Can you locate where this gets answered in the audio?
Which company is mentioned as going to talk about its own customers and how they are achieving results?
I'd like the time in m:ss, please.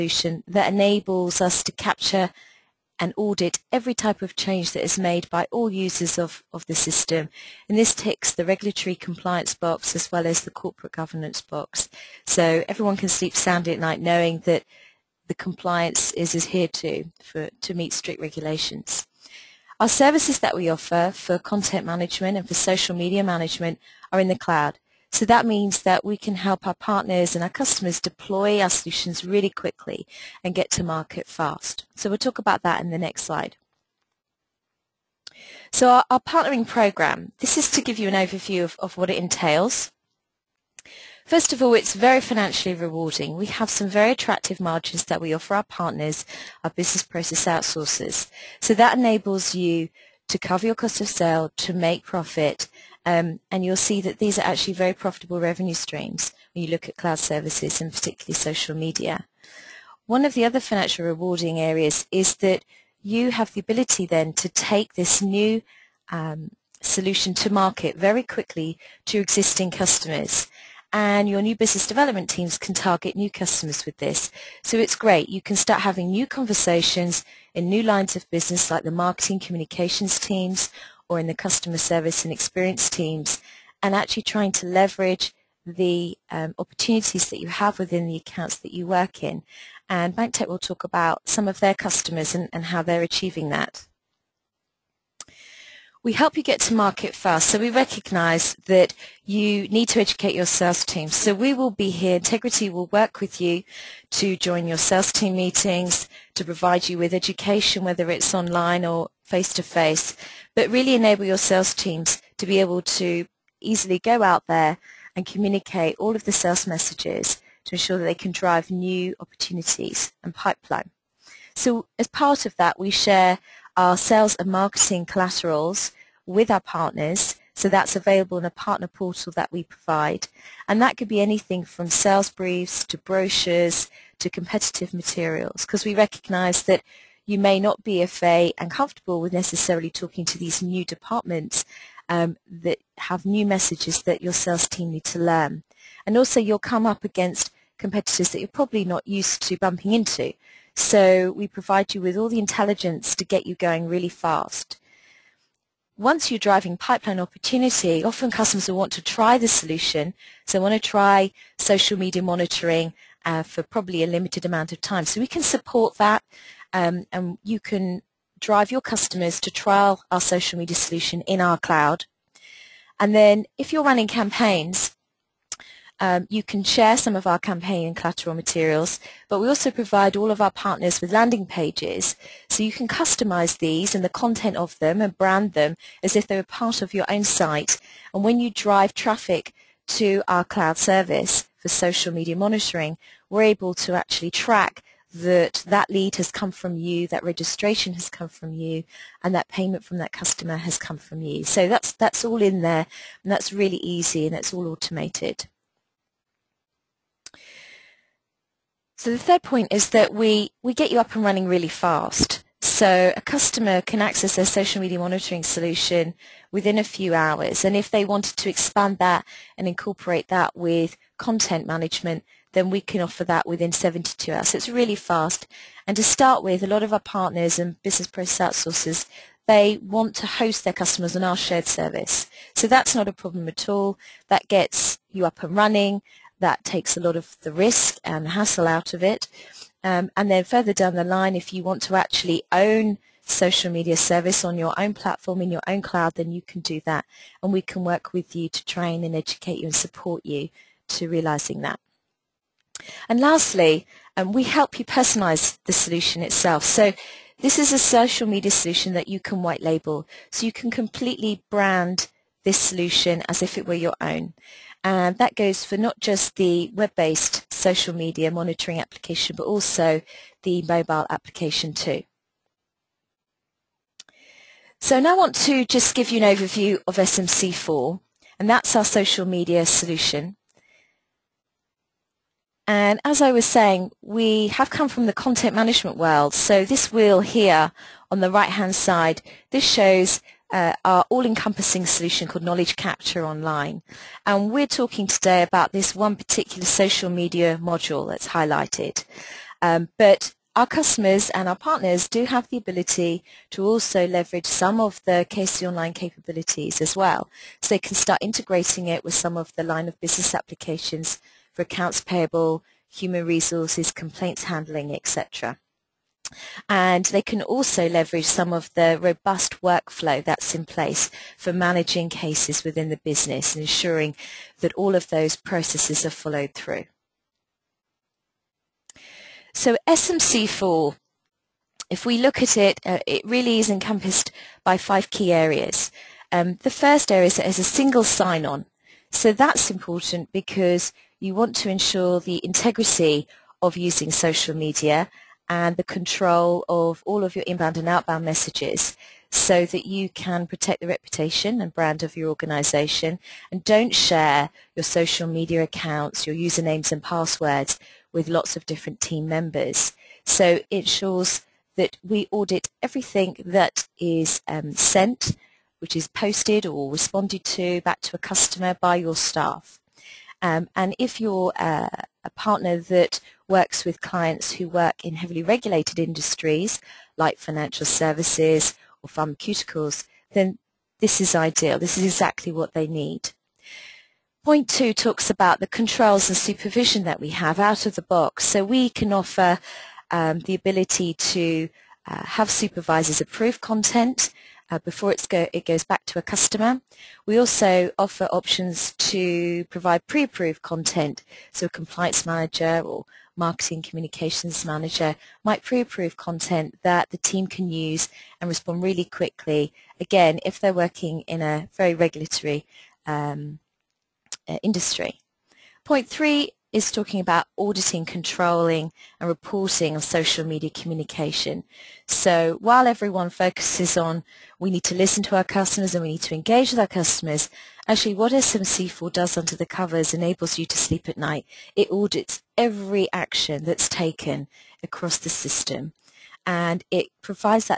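1:30.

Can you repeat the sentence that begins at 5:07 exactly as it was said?
So they can start integrating it with some of the line of business applications for accounts payable, human resources, complaints handling, etc.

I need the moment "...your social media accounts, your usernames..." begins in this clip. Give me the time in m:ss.
5:54.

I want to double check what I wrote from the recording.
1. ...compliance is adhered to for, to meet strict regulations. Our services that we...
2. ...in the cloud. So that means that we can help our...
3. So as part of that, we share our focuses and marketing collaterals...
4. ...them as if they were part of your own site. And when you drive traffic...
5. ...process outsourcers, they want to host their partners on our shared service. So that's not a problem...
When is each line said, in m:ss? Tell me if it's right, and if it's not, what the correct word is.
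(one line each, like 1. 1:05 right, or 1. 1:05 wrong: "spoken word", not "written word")
1. 0:15 right
2. 0:24 right
3. 2:01 wrong: "sales", not "focuses"
4. 3:05 right
5. 3:48 wrong: "customers", not "partners".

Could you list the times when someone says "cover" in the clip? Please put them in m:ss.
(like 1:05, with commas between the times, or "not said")
0:50, 7:09.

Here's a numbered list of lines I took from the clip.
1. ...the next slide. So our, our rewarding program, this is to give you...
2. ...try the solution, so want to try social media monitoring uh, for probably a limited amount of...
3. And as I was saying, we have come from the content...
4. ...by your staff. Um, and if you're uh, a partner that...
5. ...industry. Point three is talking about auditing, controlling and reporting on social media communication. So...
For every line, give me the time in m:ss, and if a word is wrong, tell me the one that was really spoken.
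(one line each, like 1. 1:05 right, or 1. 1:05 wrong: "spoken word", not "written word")
1. 0:32 wrong: "partnering", not "rewarding"
2. 2:39 right
3. 4:42 right
4. 6:08 right
5. 6:54 right.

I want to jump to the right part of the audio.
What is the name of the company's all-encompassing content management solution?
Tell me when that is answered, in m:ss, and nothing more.
4:52.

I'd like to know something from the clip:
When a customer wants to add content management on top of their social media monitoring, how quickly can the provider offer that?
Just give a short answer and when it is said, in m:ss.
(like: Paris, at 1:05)
72 hours, at 3:43.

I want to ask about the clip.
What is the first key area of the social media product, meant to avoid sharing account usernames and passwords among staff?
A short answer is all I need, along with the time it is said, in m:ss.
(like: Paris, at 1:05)
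single sign-on, at 5:37.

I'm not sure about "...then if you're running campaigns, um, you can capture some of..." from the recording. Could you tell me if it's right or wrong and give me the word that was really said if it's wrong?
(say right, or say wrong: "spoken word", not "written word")
wrong: "share", not "capture".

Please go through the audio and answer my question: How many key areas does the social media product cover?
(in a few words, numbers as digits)
5.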